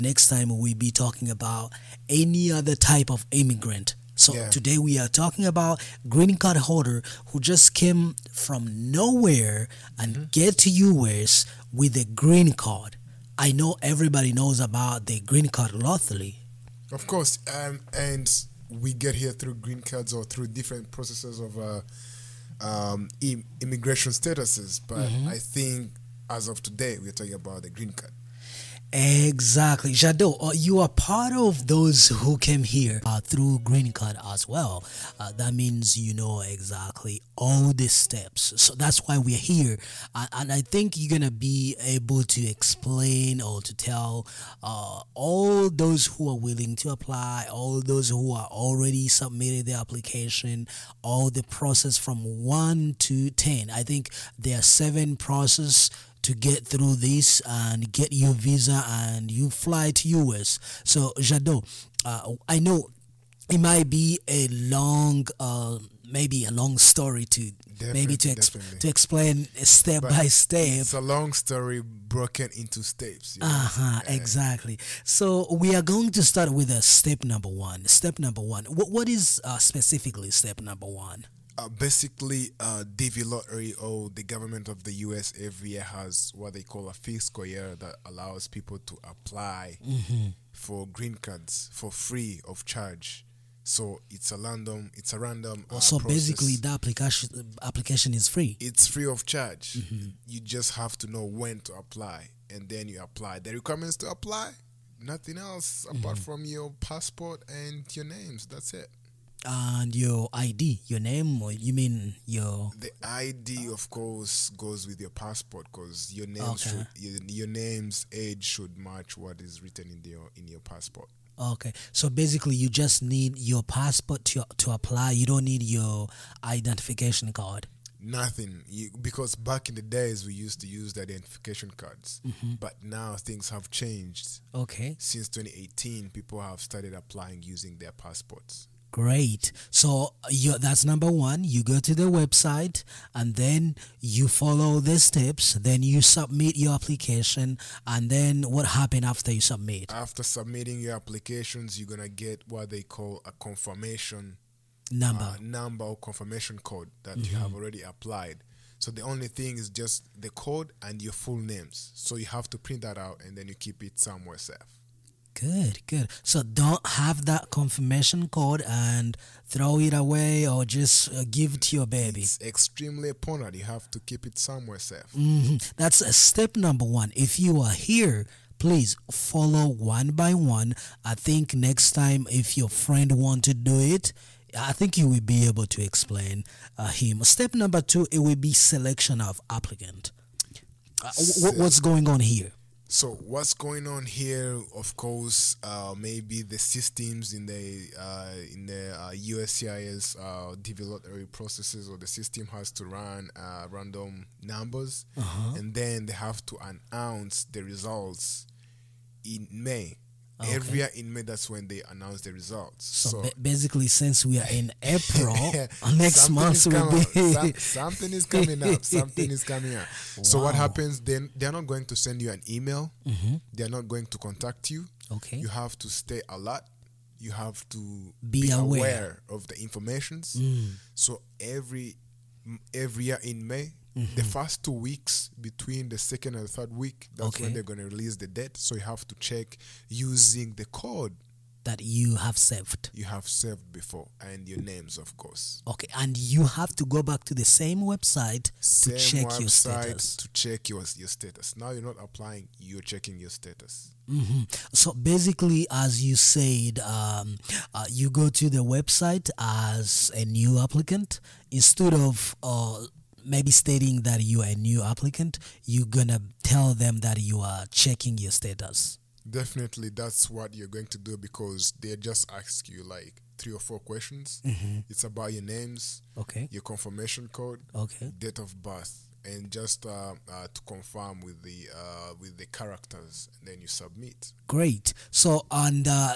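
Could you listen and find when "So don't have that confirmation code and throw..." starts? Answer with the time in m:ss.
2:46.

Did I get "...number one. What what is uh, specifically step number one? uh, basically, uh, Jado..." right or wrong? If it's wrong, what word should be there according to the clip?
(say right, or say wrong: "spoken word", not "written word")
wrong: "Davy", not "Jado".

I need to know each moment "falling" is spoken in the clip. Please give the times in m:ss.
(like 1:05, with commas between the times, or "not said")
not said.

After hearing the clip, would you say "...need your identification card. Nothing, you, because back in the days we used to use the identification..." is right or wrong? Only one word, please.
right.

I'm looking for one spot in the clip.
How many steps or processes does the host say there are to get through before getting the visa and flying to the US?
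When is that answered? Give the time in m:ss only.
0:54.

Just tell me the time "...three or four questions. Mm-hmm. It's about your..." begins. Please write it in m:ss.
4:33.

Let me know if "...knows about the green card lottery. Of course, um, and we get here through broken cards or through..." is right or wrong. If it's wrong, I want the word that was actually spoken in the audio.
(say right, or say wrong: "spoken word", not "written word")
wrong: "green", not "broken".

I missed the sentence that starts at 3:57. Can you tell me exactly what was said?
when they're going to release the debt.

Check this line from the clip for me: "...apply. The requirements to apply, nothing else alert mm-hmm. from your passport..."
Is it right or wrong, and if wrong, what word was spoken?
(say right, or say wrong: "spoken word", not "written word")
wrong: "apart", not "alert".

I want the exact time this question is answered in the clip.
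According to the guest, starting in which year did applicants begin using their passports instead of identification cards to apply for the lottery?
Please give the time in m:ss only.
2:15.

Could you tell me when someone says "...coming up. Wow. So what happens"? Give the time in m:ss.
3:39.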